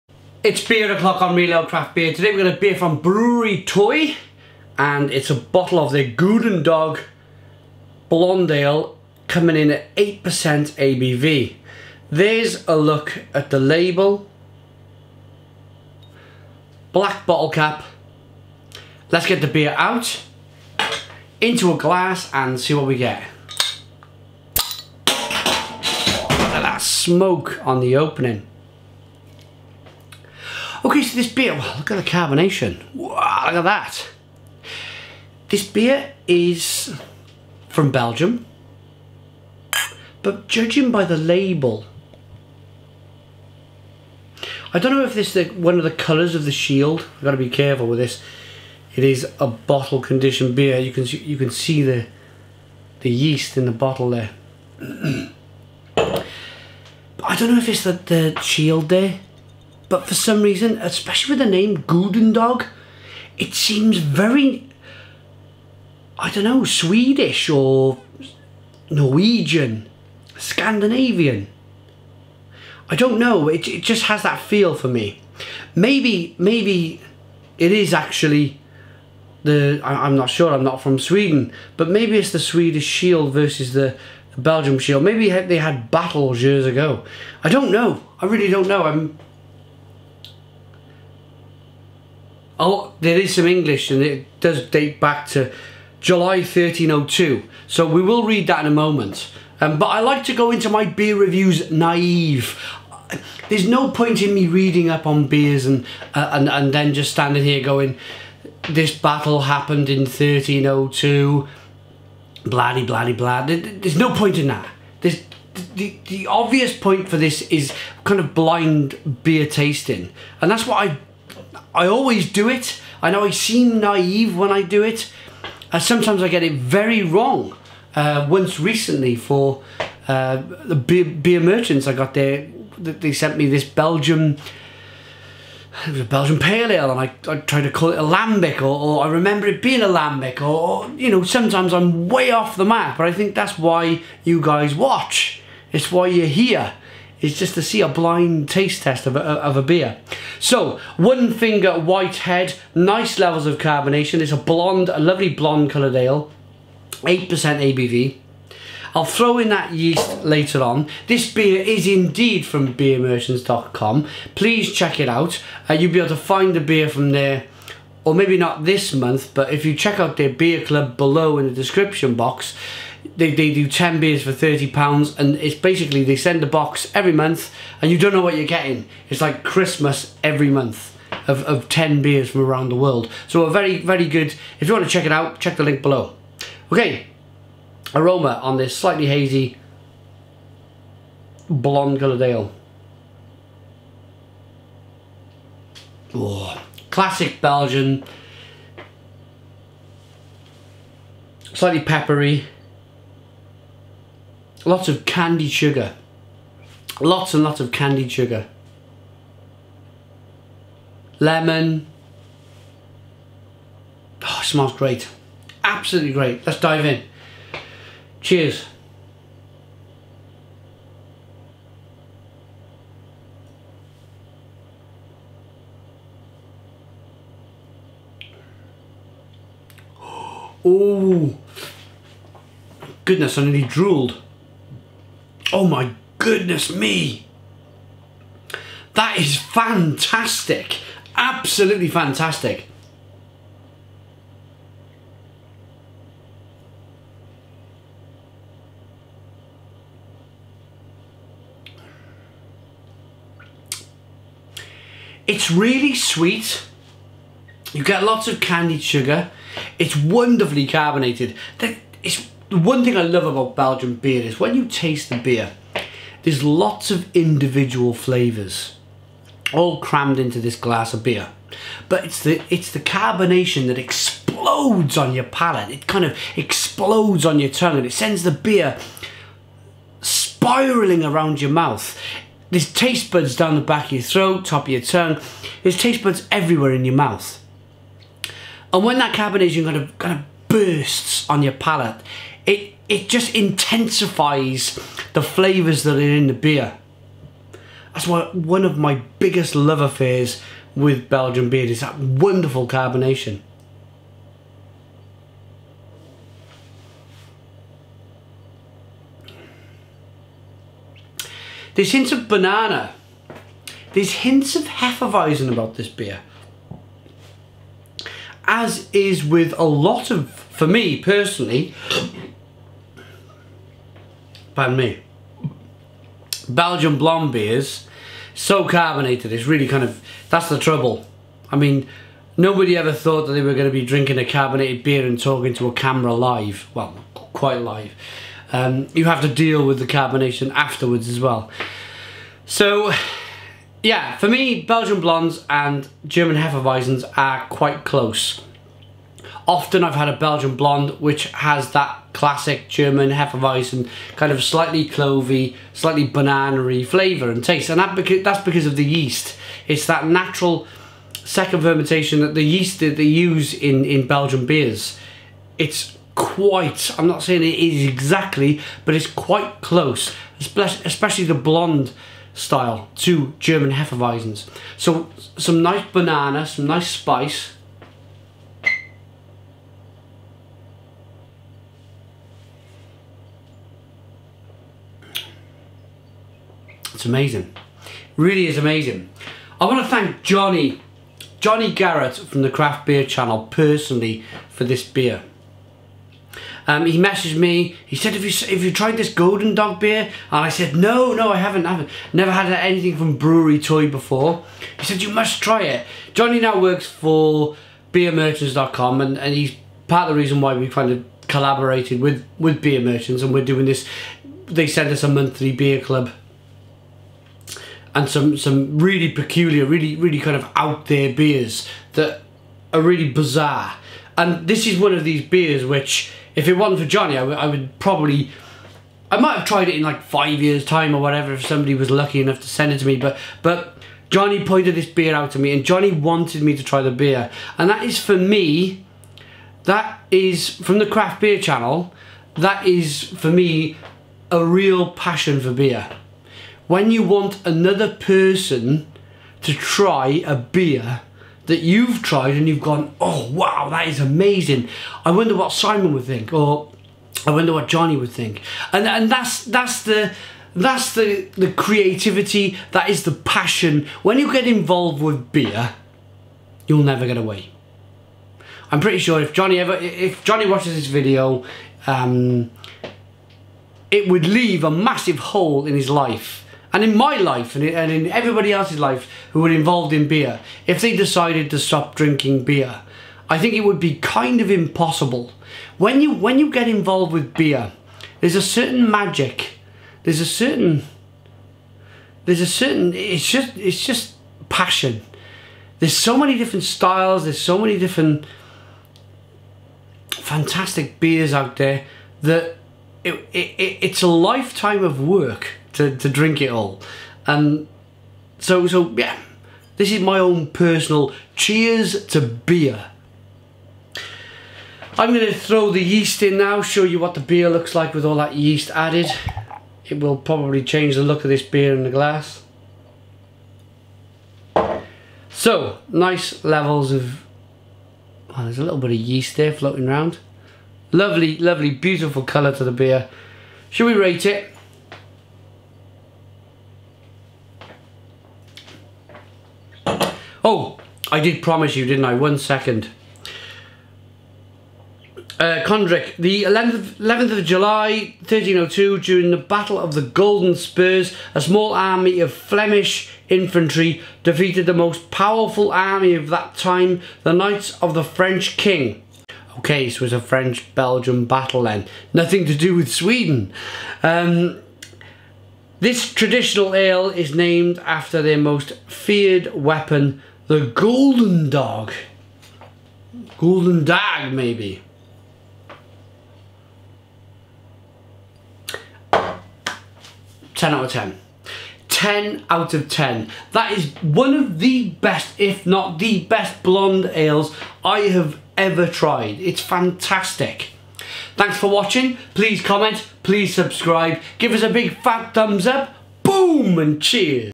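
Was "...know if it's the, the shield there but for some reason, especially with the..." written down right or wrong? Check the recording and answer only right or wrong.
right.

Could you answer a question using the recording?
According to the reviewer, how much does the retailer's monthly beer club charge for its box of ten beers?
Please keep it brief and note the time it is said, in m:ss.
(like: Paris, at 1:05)
30 pounds, at 2:54.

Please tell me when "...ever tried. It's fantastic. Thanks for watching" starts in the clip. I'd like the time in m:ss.
9:48.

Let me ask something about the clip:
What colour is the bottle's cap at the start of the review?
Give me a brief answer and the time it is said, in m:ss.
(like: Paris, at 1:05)
Black, at 0:16.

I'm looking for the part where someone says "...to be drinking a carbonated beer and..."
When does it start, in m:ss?
5:33.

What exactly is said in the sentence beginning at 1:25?
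Maybe they had battles years ago.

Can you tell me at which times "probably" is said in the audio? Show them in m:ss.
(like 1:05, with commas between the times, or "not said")
7:07, 8:40.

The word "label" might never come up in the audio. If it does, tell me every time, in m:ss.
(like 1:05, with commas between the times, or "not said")
0:13, 0:41.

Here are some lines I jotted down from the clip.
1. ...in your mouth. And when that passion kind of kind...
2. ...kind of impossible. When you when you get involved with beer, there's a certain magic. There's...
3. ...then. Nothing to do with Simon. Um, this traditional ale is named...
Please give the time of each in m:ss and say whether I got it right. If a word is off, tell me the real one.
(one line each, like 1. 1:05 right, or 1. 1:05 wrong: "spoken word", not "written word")
1. 4:46 wrong: "carbonation", not "passion"
2. 8:03 right
3. 9:21 wrong: "Sweden", not "Simon".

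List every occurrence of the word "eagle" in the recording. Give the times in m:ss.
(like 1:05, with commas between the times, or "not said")
not said.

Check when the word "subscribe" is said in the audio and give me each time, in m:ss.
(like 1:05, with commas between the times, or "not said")
9:53.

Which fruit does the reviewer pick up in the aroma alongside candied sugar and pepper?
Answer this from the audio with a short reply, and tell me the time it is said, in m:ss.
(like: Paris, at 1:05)
Lemon, at 3:31.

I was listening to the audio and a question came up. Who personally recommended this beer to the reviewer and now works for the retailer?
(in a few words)
Johnny Garrett.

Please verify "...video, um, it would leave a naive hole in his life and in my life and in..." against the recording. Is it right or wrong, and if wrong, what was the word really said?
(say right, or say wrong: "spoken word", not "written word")
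wrong: "massive", not "naive".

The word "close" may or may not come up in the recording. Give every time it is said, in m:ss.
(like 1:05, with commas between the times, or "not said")
5:47, 6:09.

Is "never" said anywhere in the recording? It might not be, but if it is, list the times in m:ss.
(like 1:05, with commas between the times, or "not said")
6:42, 7:46.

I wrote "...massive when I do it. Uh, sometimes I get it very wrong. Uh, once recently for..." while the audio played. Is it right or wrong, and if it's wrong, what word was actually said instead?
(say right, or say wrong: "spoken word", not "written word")
wrong: "naive", not "massive".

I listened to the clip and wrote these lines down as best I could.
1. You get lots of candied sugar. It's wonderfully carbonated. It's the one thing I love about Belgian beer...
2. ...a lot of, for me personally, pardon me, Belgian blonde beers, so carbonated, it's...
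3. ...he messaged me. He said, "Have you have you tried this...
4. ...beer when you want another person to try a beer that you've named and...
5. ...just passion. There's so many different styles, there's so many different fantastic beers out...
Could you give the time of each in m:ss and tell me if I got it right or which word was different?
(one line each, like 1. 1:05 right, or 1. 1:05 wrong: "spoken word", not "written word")
1. 4:17 right
2. 5:19 right
3. 6:36 right
4. 7:25 wrong: "tried", not "named"
5. 8:13 right.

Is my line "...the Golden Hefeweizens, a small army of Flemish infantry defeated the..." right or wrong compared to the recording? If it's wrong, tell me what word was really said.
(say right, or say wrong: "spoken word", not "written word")
wrong: "Spurs", not "Hefeweizens".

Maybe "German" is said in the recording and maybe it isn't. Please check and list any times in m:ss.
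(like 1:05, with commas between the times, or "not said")
5:46, 5:52, 6:13.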